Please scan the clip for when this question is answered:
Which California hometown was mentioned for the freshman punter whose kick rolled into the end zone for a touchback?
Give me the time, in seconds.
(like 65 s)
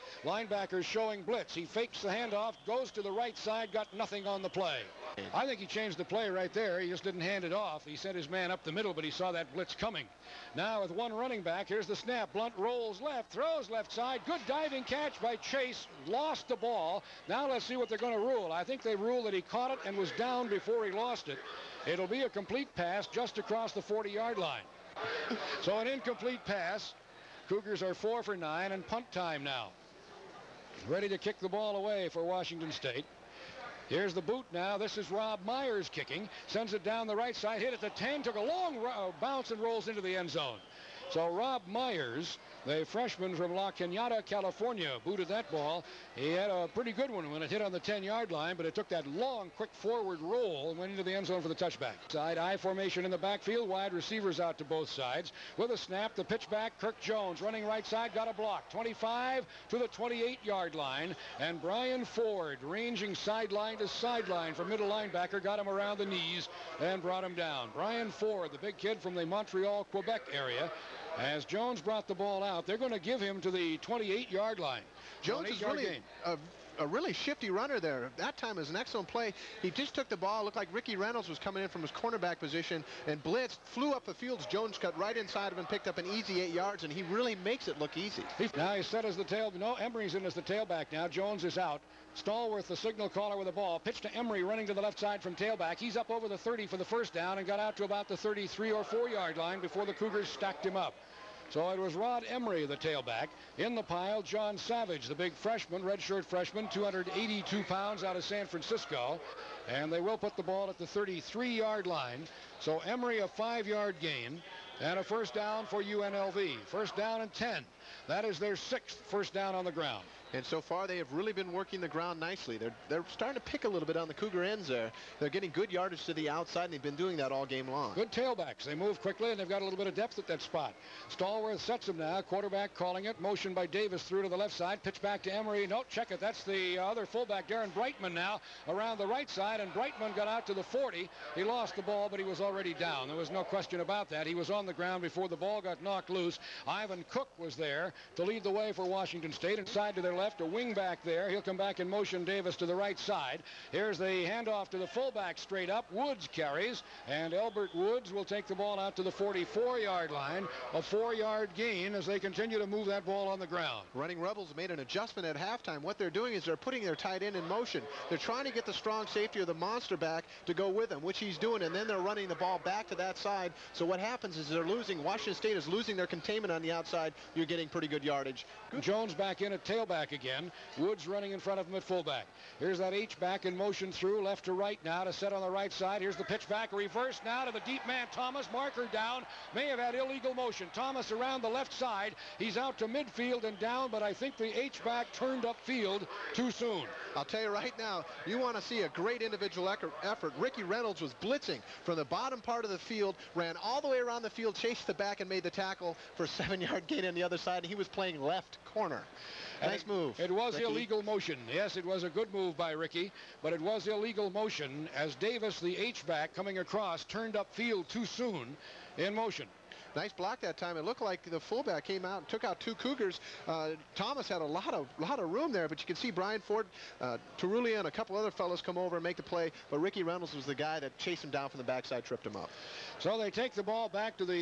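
43 s.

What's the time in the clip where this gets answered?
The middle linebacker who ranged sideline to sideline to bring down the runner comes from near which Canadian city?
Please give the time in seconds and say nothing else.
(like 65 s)
69 s.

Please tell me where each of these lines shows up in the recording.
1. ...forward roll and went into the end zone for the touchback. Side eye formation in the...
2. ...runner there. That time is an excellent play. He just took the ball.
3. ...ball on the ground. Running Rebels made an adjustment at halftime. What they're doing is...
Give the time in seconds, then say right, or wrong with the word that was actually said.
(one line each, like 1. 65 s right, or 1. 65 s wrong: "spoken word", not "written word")
1. 49 s right
2. 77 s right
3. 163 s right.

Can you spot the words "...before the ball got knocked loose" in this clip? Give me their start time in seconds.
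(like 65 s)
145 s.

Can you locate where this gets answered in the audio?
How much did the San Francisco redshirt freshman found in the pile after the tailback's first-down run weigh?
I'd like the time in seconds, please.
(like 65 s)
106 s.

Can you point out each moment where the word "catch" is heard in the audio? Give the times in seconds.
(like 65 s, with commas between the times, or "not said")
14 s.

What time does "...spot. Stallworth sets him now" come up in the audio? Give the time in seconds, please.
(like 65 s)
130 s.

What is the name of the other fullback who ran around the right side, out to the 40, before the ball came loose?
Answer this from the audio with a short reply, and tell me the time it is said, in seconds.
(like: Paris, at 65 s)
Darren Brightman, at 137 s.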